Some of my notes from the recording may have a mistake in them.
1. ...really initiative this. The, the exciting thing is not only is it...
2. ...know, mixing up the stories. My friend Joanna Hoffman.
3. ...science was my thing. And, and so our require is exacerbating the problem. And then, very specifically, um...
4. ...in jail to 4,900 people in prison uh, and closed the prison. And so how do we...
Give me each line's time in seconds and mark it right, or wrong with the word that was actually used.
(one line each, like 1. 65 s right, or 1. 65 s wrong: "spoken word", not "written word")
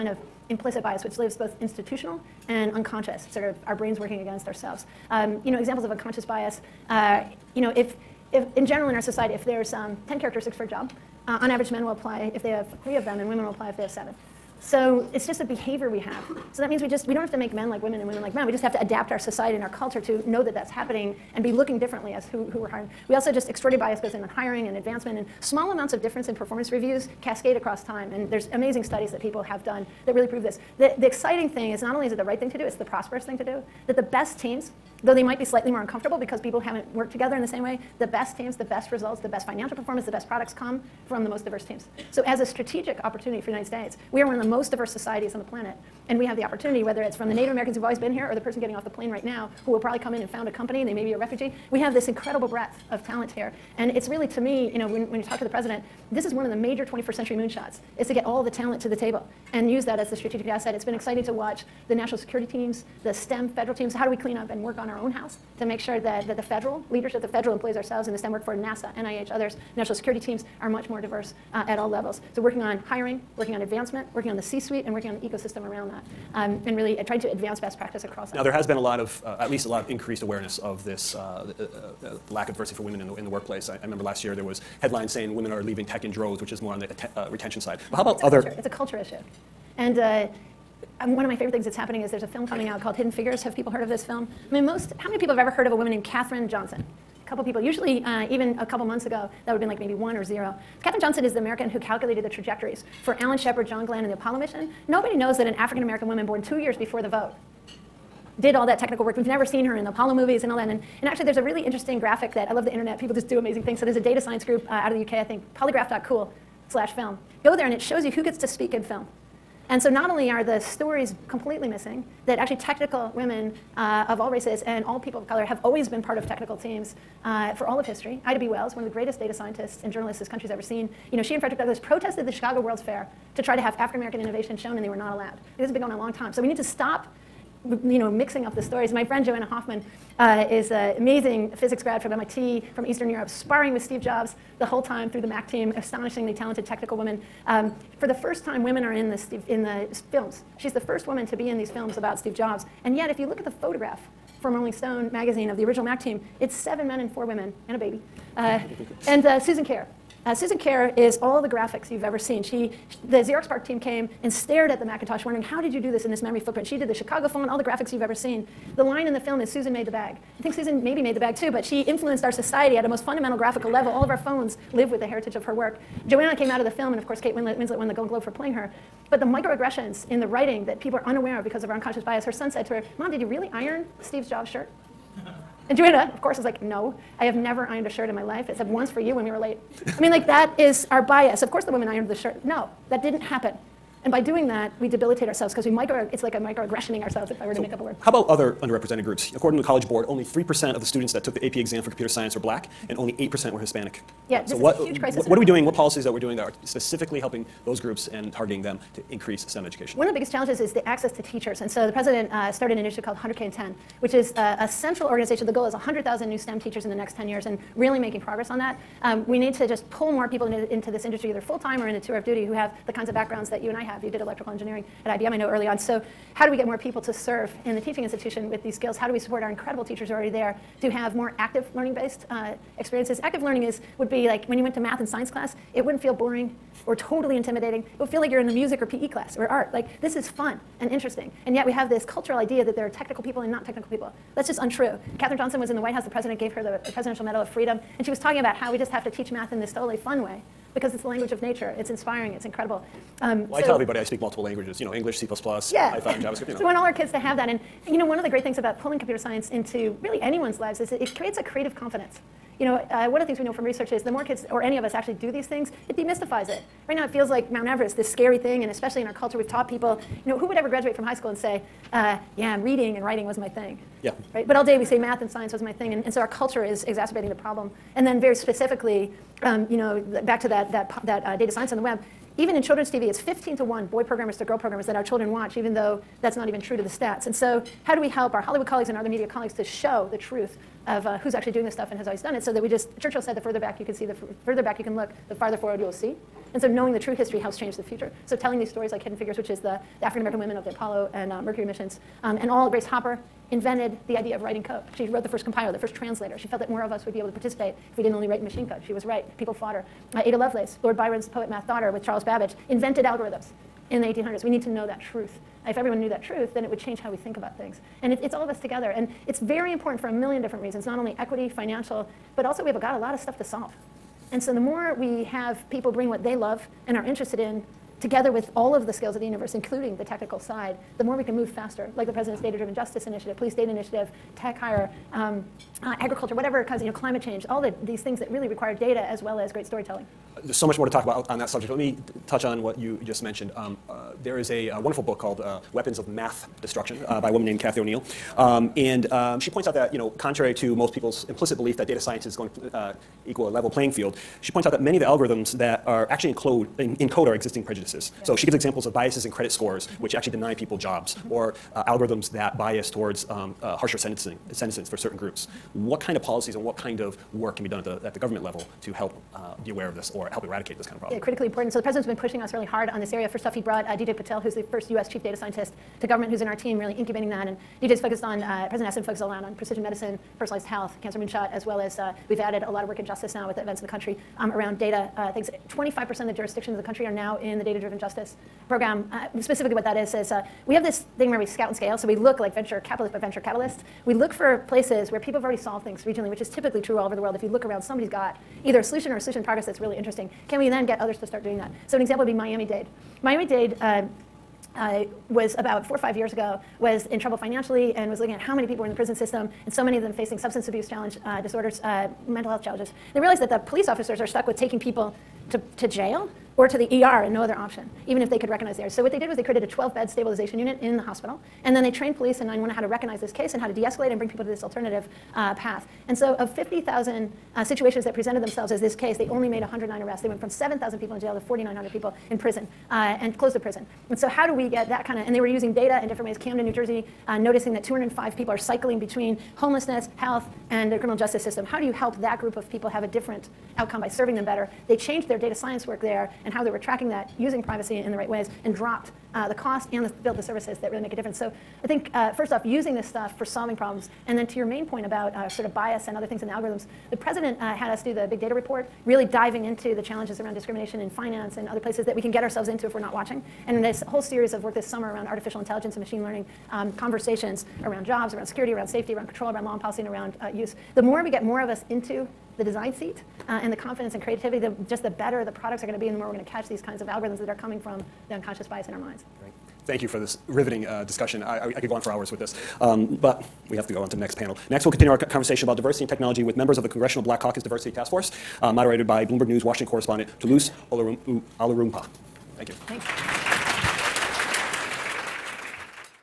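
1. 30 s wrong: "prove", not "initiative"
2. 137 s right
3. 275 s wrong: "culture", not "require"
4. 431 s right.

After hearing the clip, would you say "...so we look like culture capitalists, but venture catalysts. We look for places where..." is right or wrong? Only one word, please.
wrong.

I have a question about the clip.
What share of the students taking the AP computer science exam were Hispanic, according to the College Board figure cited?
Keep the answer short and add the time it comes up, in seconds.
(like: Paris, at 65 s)
8%, at 203 s.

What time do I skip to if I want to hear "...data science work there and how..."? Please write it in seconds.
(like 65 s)
445 s.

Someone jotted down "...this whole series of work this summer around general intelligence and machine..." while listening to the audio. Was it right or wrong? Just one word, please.
wrong.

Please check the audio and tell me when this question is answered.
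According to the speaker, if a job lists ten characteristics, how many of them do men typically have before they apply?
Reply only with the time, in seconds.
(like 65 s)
12 s.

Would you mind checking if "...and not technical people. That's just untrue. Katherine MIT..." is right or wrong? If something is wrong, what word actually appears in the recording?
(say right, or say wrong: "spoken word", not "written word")
wrong: "Johnson", not "MIT".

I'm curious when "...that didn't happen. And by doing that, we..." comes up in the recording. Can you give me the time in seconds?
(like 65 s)
192 s.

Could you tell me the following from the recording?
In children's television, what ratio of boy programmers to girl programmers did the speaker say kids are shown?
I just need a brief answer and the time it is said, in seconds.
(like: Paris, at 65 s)
15 to 1, at 283 s.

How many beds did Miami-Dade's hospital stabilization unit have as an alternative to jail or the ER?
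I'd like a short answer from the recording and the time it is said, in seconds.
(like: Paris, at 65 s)
12, at 419 s.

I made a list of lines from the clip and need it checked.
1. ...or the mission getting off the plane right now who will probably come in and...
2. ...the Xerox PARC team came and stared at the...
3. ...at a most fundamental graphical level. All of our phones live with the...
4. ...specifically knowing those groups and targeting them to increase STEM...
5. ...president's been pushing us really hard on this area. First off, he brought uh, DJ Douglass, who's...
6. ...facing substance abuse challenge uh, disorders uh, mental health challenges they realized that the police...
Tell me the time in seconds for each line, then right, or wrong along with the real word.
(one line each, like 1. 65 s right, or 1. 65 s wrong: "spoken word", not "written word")
1. 48 s wrong: "person", not "mission"
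2. 163 s right
3. 172 s right
4. 206 s wrong: "helping", not "knowing"
5. 371 s wrong: "Patil", not "Douglass"
6. 410 s right.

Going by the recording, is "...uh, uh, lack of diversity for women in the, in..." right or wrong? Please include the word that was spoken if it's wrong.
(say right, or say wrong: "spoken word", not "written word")
right.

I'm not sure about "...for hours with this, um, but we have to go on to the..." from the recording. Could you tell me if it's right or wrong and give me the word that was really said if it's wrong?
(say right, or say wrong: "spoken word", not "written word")
right.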